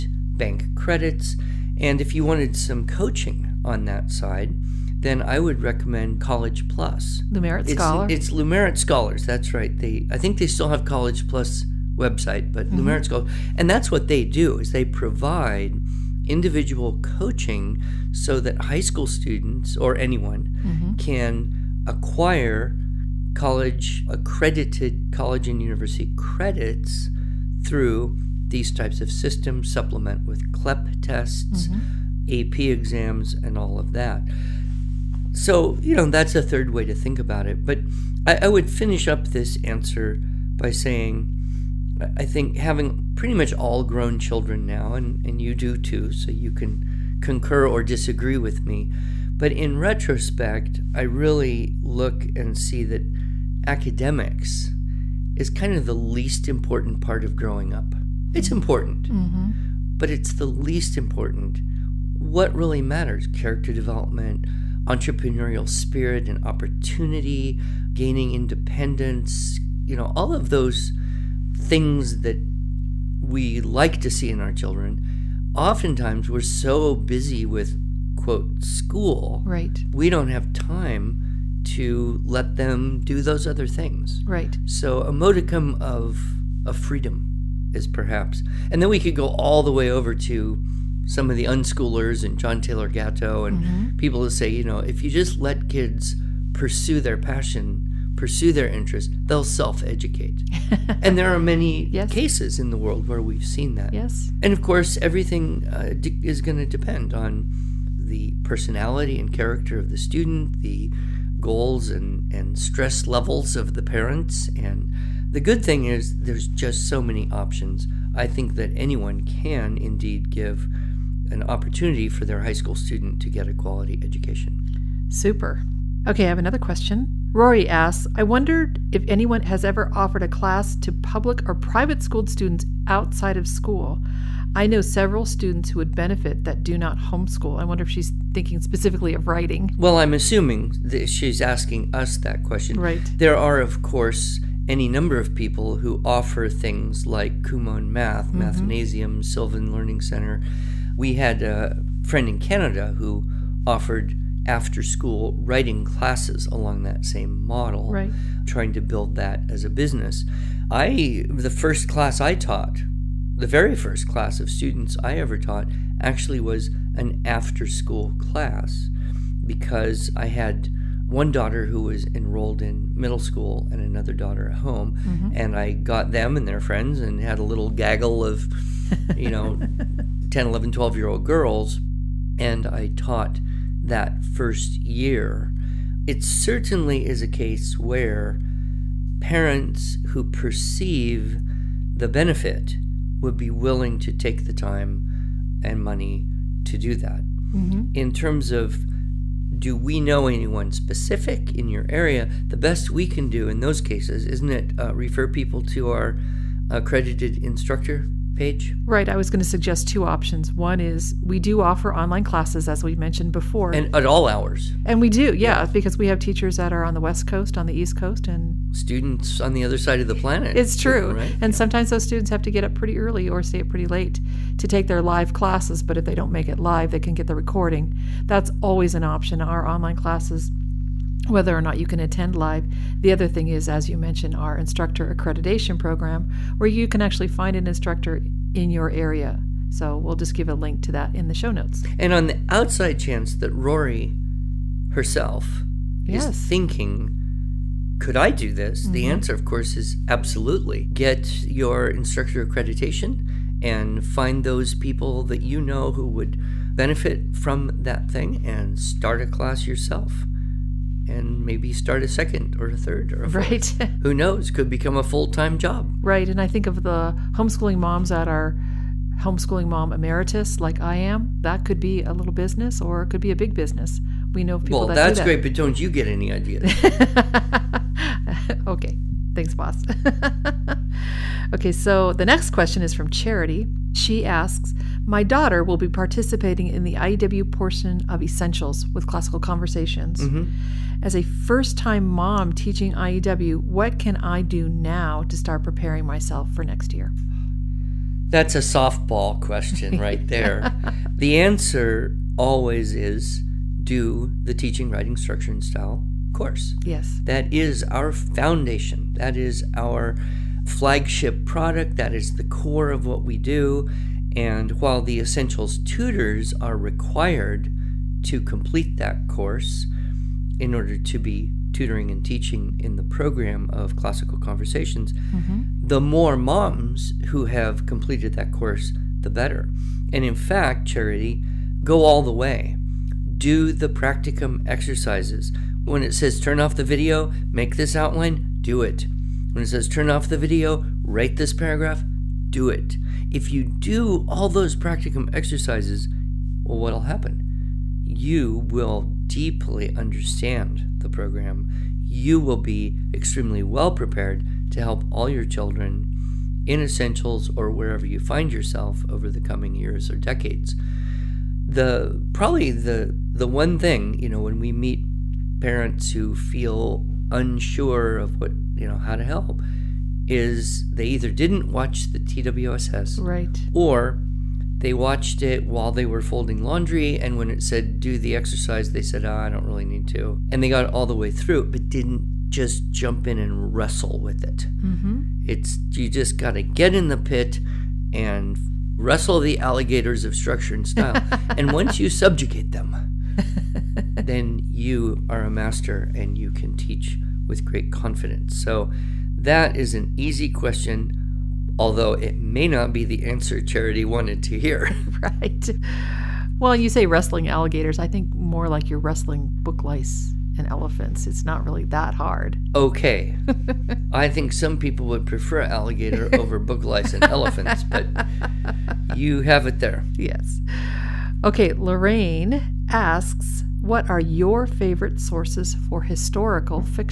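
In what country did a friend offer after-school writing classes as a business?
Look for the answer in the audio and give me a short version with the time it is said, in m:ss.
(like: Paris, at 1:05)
Canada, at 2:32.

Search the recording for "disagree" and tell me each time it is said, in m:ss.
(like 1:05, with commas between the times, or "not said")
0:47.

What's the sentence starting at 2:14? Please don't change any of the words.
I know several students who would benefit that do not homeschool.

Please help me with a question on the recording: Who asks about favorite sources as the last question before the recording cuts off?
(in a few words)
Lorraine.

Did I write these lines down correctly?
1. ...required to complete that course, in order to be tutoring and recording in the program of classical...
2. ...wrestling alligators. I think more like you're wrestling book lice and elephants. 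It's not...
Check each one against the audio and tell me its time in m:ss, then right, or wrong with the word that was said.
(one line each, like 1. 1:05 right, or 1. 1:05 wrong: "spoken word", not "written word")
1. 5:16 wrong: "teaching", not "recording"
2. 6:47 right.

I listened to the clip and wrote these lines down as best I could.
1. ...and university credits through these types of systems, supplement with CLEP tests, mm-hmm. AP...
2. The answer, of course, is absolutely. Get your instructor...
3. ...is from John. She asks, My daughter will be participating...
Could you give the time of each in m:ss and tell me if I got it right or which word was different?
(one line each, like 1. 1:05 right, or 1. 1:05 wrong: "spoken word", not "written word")
1. 0:25 right
2. 4:08 right
3. 4:42 wrong: "Charity", not "John".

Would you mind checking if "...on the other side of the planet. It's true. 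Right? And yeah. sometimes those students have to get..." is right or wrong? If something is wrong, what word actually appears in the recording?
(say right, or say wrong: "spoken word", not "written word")
right.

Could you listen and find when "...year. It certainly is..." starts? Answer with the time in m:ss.
3:04.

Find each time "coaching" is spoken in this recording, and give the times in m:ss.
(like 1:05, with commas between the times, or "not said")
0:02, 0:17.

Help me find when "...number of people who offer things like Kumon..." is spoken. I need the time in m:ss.
2:24.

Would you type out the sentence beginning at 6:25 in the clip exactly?
It's you just got to get in the pit and wrestle the alligators of structure and style.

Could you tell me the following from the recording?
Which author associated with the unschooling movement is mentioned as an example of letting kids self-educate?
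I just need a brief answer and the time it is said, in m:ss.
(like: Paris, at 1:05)
John Taylor Gatto, at 1:32.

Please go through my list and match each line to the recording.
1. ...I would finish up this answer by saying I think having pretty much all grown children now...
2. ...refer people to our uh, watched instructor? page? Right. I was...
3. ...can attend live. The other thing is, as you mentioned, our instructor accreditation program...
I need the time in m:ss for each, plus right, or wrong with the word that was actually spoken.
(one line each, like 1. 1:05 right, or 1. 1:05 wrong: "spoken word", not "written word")
1. 0:38 right
2. 3:24 wrong: "accredited", not "watched"
3. 3:51 right.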